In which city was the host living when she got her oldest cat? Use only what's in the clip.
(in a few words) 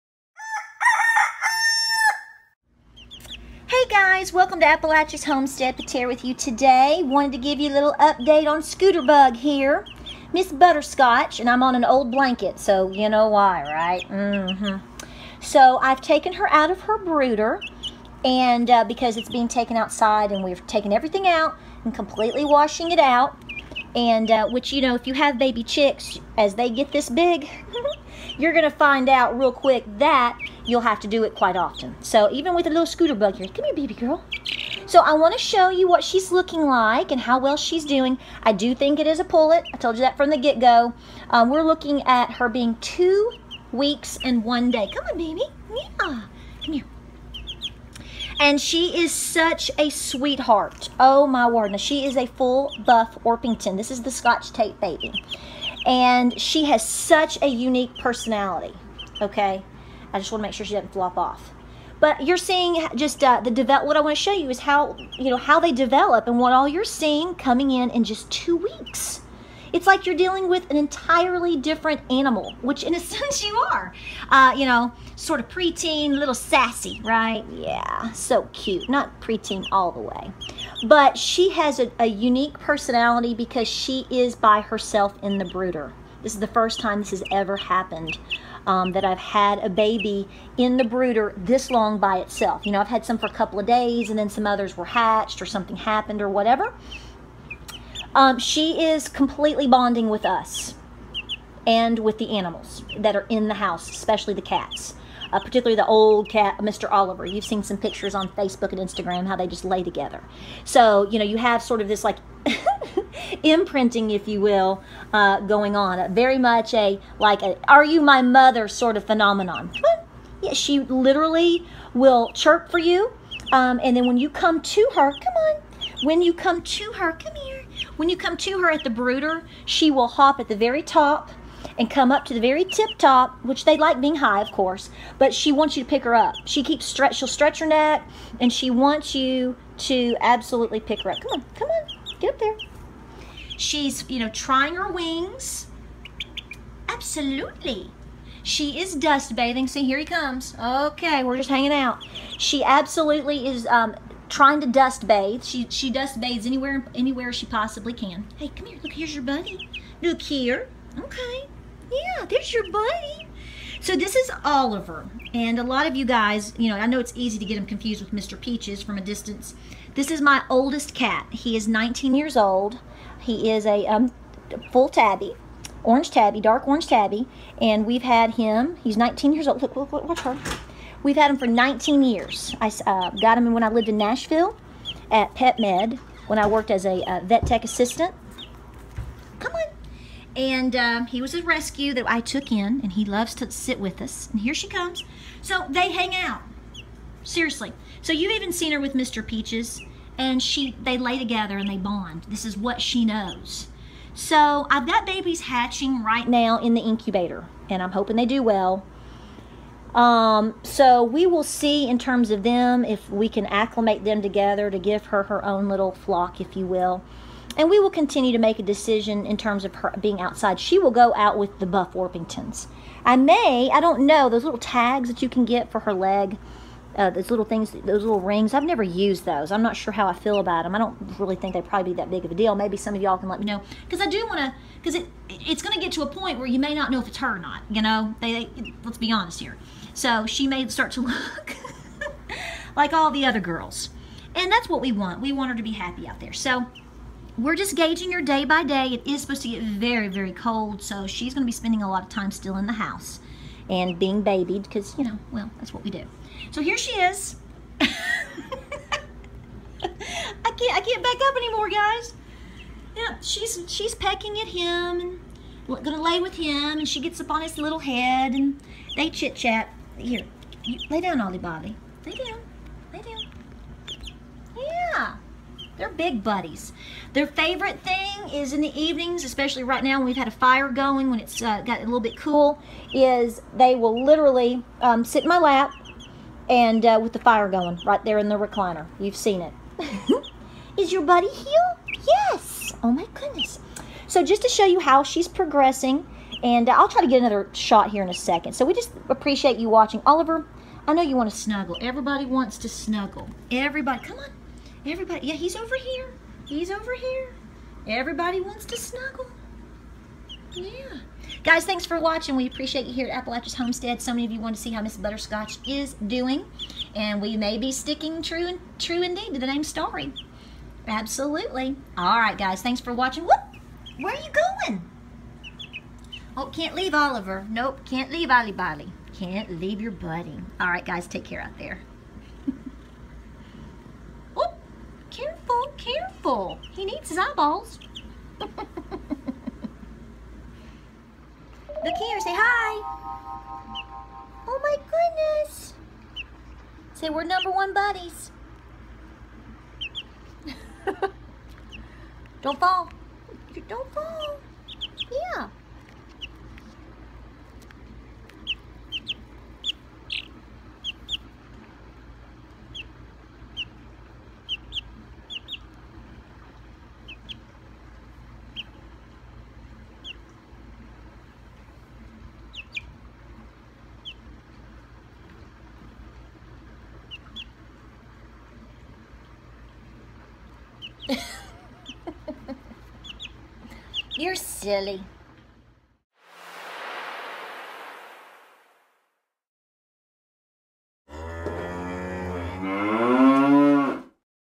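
Nashville.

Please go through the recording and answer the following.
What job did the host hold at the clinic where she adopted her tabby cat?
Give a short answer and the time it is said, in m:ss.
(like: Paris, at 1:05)
vet tech assistant, at 3:07.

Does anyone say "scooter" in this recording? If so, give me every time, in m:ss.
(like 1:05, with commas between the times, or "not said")
0:08, 0:32.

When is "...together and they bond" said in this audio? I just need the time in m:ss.
3:21.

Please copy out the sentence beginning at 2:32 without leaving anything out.
She absolutely is um, trying to dust bathe.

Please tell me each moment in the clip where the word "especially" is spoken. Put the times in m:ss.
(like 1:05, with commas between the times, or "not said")
1:43, 4:39.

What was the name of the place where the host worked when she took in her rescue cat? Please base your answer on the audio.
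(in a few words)
Pet Med.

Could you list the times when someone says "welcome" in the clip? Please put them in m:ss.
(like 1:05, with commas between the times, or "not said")
0:04.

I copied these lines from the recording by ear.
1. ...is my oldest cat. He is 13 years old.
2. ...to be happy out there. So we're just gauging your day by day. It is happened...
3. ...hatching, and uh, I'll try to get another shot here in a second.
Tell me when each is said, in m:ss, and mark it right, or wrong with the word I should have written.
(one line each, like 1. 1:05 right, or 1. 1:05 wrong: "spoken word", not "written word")
1. 2:50 wrong: "19", not "13"
2. 4:05 wrong: "supposed", not "happened"
3. 4:55 wrong: "progressing", not "hatching".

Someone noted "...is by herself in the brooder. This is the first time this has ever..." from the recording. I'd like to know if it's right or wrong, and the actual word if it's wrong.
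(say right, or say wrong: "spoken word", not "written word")
right.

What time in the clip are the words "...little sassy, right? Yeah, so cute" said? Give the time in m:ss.
1:16.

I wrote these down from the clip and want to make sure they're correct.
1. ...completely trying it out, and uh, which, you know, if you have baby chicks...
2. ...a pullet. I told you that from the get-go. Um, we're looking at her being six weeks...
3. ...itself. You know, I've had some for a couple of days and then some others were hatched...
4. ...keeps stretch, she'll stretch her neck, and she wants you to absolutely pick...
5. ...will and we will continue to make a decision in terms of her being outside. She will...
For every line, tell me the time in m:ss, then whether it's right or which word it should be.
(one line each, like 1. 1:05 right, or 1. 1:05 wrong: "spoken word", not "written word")
1. 0:21 wrong: "washing", not "trying"
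2. 0:39 wrong: "two", not "six"
3. 1:32 right
4. 2:16 right
5. 3:36 right.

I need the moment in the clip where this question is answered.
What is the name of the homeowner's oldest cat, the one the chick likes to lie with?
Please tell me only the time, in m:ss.
1:46.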